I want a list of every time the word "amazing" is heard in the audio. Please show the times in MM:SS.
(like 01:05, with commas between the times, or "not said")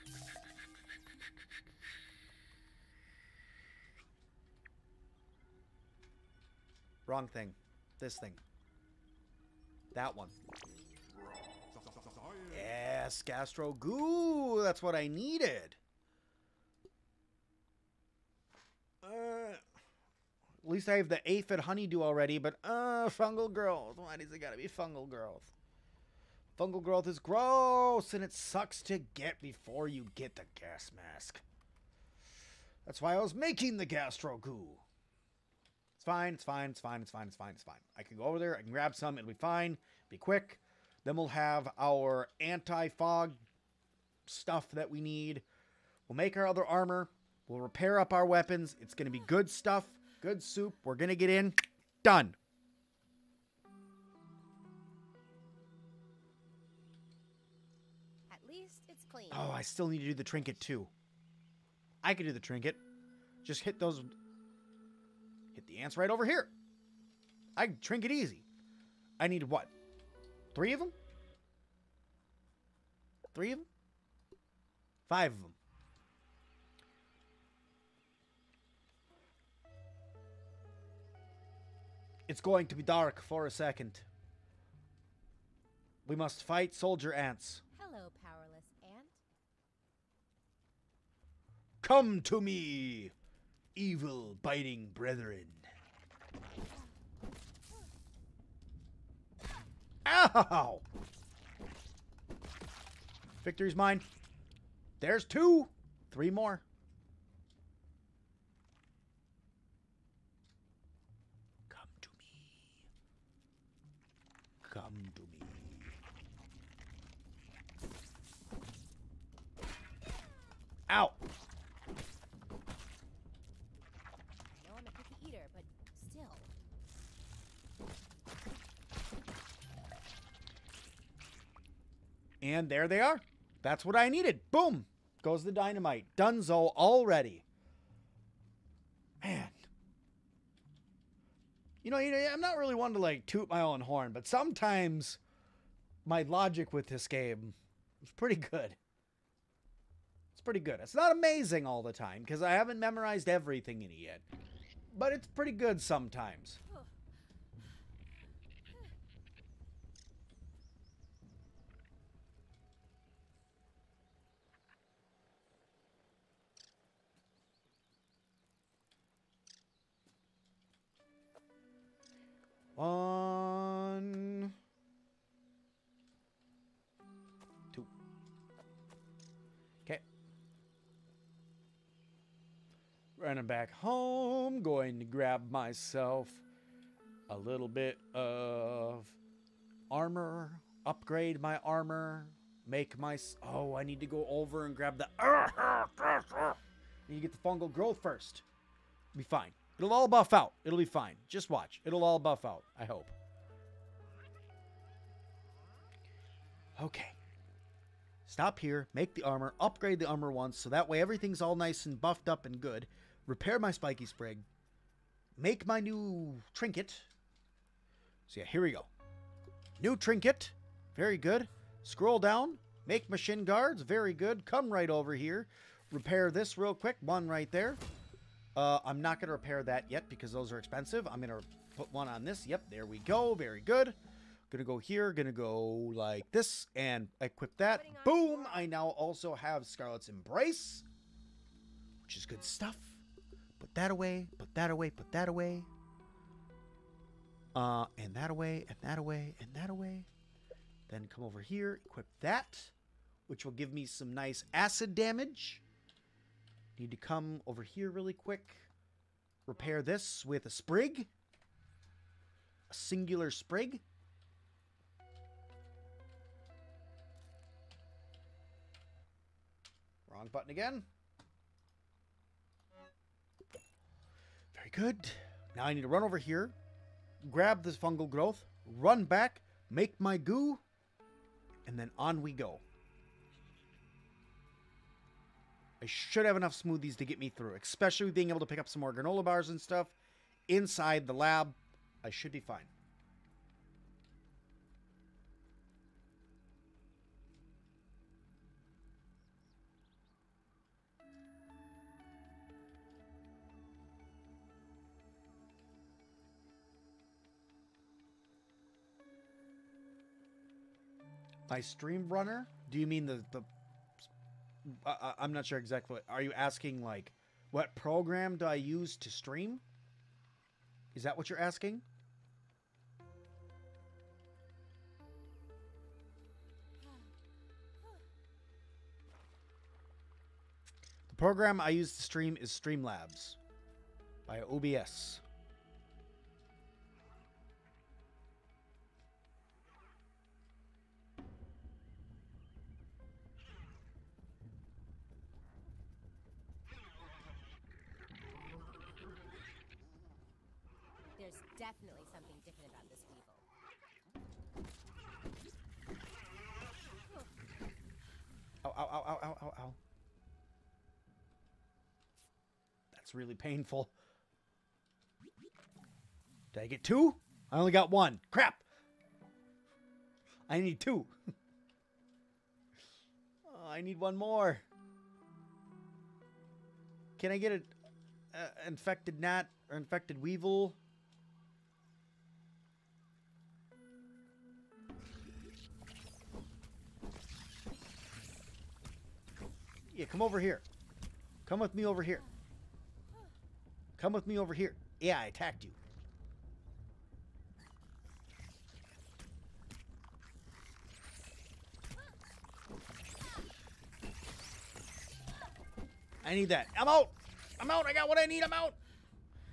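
02:31.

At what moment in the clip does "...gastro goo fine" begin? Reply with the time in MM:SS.
00:33.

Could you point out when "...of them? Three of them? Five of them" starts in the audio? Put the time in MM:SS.
01:10.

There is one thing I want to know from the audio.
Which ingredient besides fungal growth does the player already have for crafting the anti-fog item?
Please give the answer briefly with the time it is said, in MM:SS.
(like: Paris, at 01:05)
Aphid honeydew, at 00:21.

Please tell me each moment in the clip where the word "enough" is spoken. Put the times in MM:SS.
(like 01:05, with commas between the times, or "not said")
04:46.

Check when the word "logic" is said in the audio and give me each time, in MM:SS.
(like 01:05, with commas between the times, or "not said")
02:26.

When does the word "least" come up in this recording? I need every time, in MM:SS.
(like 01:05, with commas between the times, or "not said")
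00:20, 00:58.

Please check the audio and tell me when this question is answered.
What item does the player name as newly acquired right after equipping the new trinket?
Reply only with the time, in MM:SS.
03:59.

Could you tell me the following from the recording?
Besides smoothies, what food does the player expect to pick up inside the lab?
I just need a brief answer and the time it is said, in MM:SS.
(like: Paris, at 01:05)
Granola bars, at 04:48.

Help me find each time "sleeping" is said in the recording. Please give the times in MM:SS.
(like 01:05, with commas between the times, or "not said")
not said.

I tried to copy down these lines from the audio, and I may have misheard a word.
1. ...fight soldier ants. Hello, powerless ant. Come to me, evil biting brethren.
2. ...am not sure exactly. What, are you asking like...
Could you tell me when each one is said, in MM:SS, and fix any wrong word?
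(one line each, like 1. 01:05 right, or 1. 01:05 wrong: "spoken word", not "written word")
1. 01:26 right
2. 05:15 right.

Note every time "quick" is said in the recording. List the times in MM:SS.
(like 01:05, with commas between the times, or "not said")
00:40, 03:46, 04:18.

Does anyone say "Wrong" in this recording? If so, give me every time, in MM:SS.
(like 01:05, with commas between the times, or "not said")
00:07, 04:30.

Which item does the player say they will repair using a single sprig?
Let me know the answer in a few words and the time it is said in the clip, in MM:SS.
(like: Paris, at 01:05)
Spiky sprig, at 03:33.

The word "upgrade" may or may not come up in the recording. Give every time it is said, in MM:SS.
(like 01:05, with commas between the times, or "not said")
03:10, 03:29.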